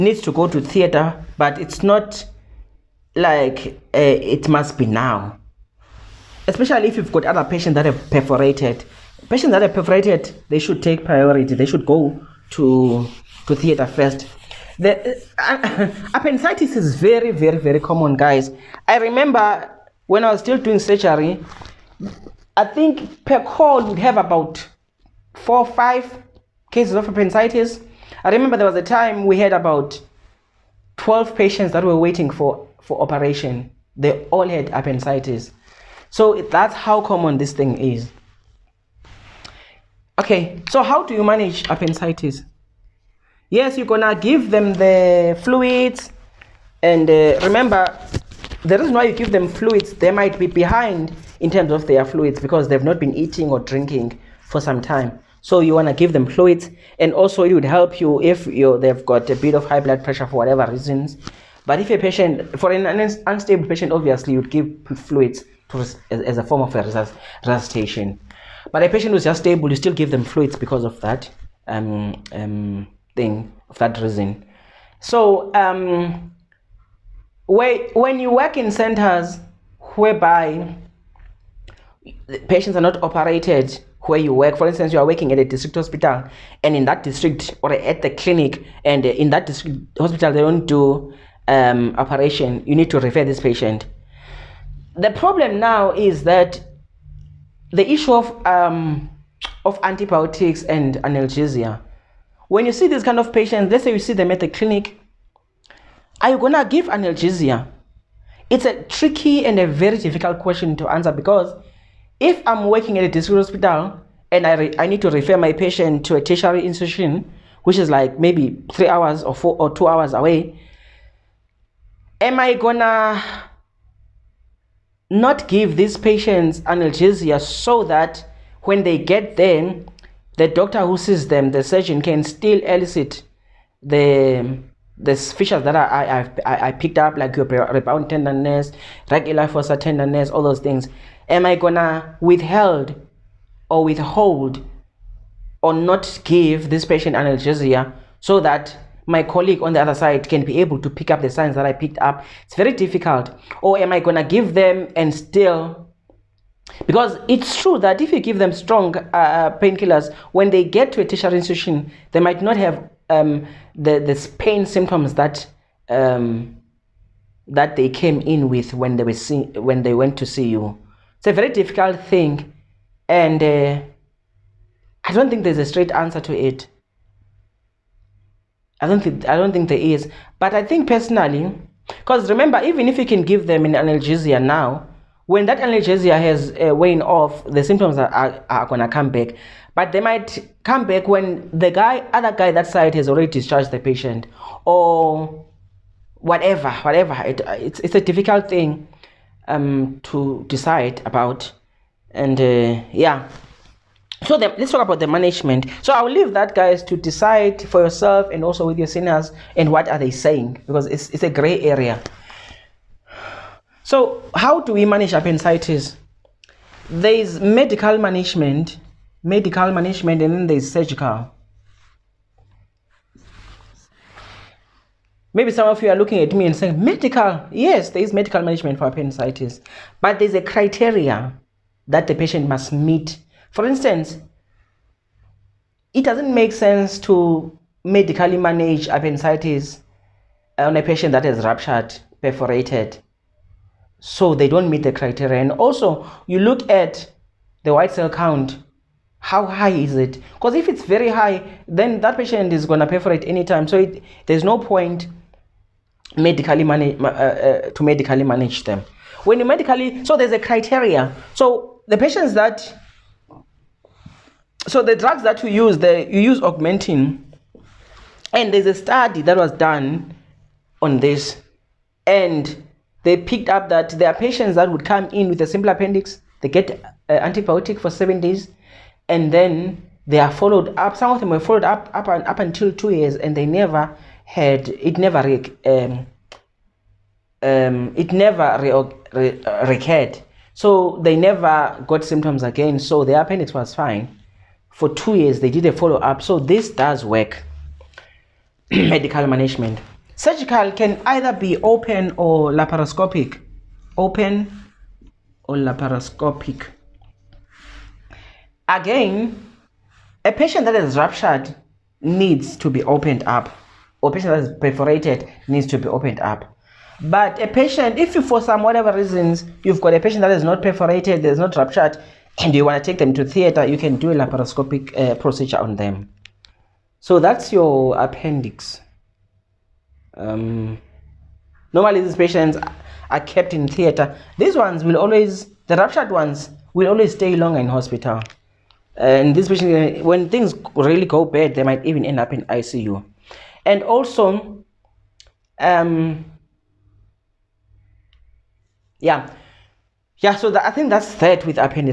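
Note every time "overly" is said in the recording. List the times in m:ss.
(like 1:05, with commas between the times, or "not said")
not said.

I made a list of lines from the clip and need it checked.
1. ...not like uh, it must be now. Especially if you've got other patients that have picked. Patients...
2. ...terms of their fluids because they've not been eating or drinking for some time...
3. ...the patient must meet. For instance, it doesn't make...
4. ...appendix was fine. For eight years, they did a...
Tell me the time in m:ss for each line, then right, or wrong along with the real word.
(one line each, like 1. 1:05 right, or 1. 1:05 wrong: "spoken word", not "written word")
1. 0:01 wrong: "perforated", not "picked"
2. 0:51 right
3. 3:52 right
4. 4:53 wrong: "two", not "eight".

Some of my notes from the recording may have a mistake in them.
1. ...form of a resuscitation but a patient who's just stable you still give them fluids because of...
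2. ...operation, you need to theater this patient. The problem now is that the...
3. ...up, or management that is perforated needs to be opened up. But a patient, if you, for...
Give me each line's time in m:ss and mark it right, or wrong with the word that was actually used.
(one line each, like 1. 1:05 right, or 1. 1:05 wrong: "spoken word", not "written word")
1. 1:06 right
2. 1:31 wrong: "refer", not "theater"
3. 5:13 wrong: "patient", not "management".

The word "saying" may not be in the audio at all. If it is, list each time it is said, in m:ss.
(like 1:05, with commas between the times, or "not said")
3:30, 3:46.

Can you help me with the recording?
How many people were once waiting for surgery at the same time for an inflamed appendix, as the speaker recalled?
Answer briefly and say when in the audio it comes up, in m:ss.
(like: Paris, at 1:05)
12, at 0:30.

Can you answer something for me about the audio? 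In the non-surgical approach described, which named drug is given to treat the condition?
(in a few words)
Augmentin.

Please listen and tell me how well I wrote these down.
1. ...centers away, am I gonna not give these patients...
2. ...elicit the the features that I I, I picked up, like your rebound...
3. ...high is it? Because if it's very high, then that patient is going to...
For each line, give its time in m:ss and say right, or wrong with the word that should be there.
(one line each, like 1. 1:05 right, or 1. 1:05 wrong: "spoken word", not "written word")
1. 1:59 wrong: "hours", not "centers"
2. 2:12 right
3. 4:09 right.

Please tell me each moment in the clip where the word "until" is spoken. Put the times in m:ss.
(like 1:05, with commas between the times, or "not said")
4:42.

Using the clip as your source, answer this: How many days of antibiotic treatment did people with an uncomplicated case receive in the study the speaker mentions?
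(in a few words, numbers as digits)
7.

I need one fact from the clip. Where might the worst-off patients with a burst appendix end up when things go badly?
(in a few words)
ICU.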